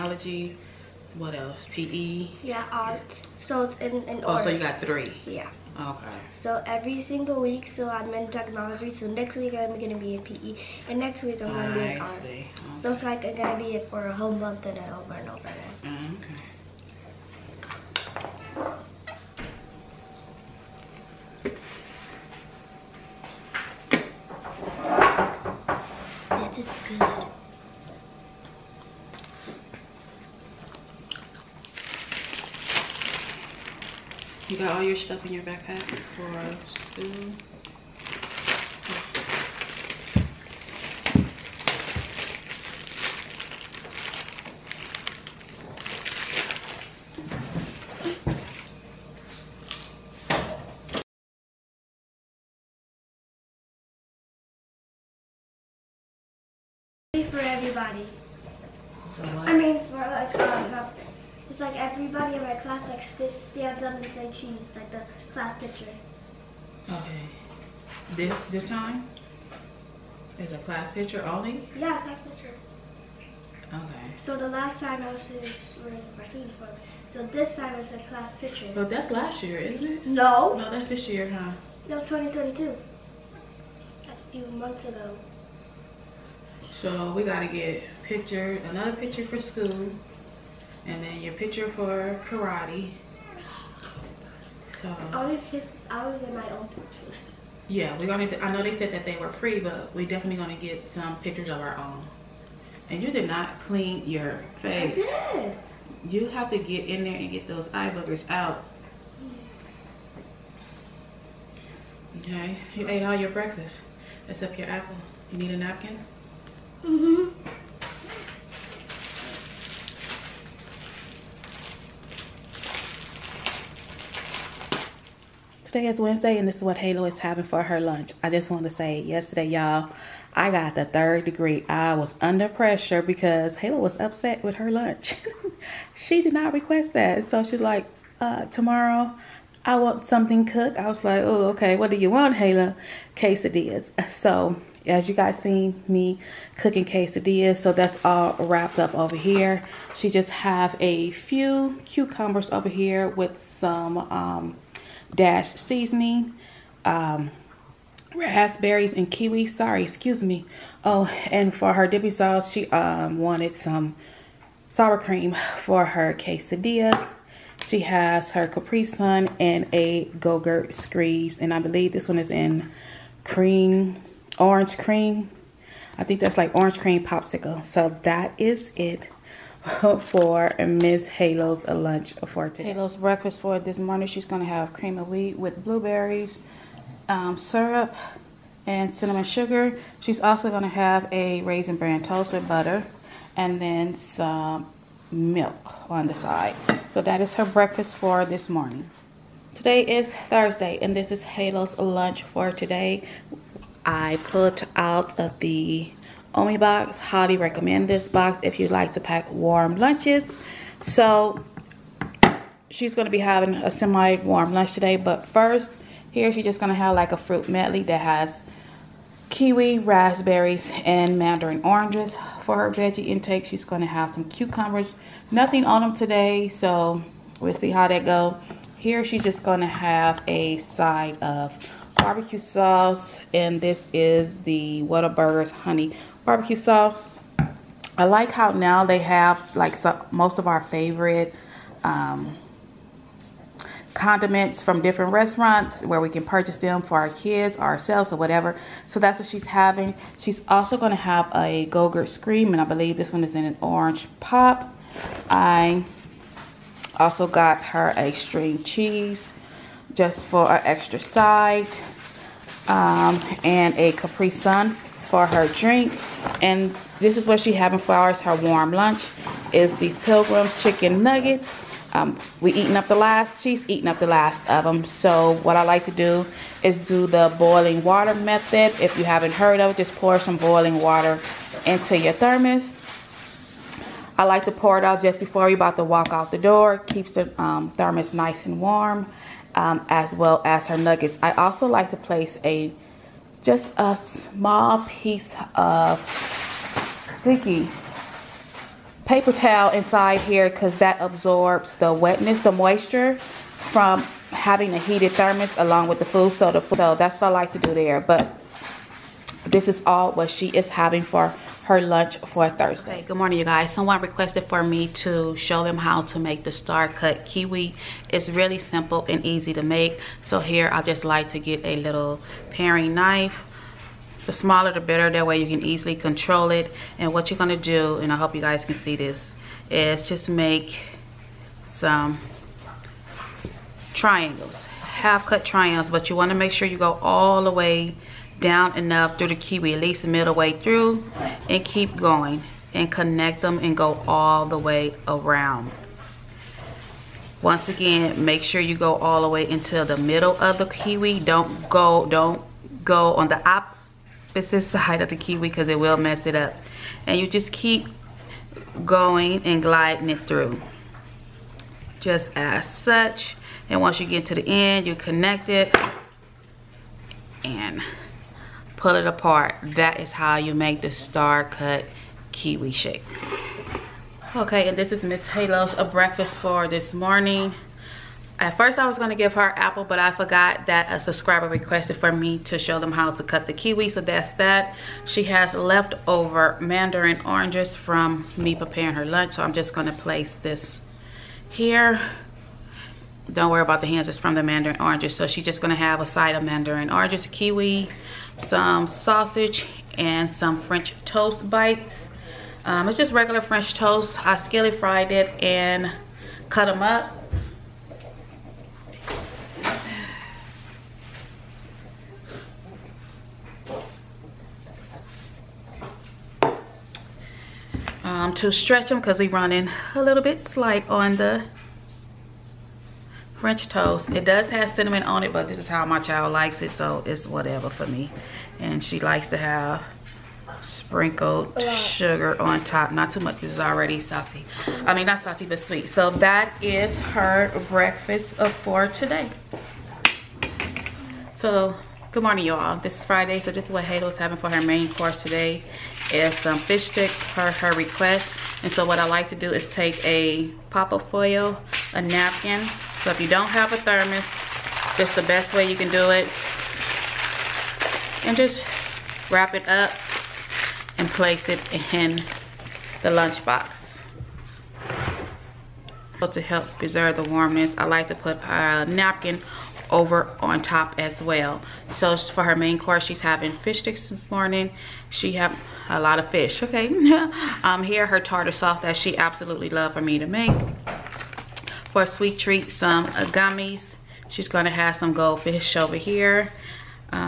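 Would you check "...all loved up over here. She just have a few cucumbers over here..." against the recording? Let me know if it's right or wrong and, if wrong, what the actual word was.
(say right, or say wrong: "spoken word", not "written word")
wrong: "wrapped", not "loved".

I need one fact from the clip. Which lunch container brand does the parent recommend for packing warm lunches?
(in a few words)
OmieBox.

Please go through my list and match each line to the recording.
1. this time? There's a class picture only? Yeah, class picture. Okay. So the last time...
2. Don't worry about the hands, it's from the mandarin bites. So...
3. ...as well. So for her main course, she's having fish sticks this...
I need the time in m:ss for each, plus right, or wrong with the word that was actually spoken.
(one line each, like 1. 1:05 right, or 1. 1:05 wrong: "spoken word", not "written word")
1. 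1:08 right
2. 6:33 wrong: "oranges", not "bites"
3. 7:50 right.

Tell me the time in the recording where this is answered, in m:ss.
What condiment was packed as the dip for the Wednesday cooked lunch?
2:44.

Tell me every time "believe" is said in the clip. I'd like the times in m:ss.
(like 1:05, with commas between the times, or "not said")
2:51, 4:12.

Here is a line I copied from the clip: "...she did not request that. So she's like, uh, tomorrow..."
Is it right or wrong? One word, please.
right.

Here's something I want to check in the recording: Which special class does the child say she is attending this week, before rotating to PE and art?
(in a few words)
technology.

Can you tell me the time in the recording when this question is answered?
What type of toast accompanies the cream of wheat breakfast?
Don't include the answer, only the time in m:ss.
3:11.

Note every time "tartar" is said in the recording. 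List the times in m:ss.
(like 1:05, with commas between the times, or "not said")
7:58.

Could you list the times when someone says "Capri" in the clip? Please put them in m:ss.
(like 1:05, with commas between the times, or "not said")
2:48, 4:23.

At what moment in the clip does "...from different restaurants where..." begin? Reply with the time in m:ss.
4:04.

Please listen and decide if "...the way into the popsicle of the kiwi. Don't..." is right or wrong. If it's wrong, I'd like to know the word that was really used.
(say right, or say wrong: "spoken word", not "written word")
wrong: "middle", not "popsicle".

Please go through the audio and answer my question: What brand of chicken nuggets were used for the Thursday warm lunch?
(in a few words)
Pilgrim's.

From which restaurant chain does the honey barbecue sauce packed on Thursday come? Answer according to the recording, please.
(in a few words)
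Whataburger.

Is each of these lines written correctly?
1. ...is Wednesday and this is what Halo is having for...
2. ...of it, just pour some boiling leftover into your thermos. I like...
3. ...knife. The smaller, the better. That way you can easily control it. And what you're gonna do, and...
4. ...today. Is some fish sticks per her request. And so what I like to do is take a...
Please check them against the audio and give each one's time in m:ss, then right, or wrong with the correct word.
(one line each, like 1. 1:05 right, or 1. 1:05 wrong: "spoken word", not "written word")
1. 2:05 right
2. 4:39 wrong: "water", not "leftover"
3. 5:22 right
4. 7:25 right.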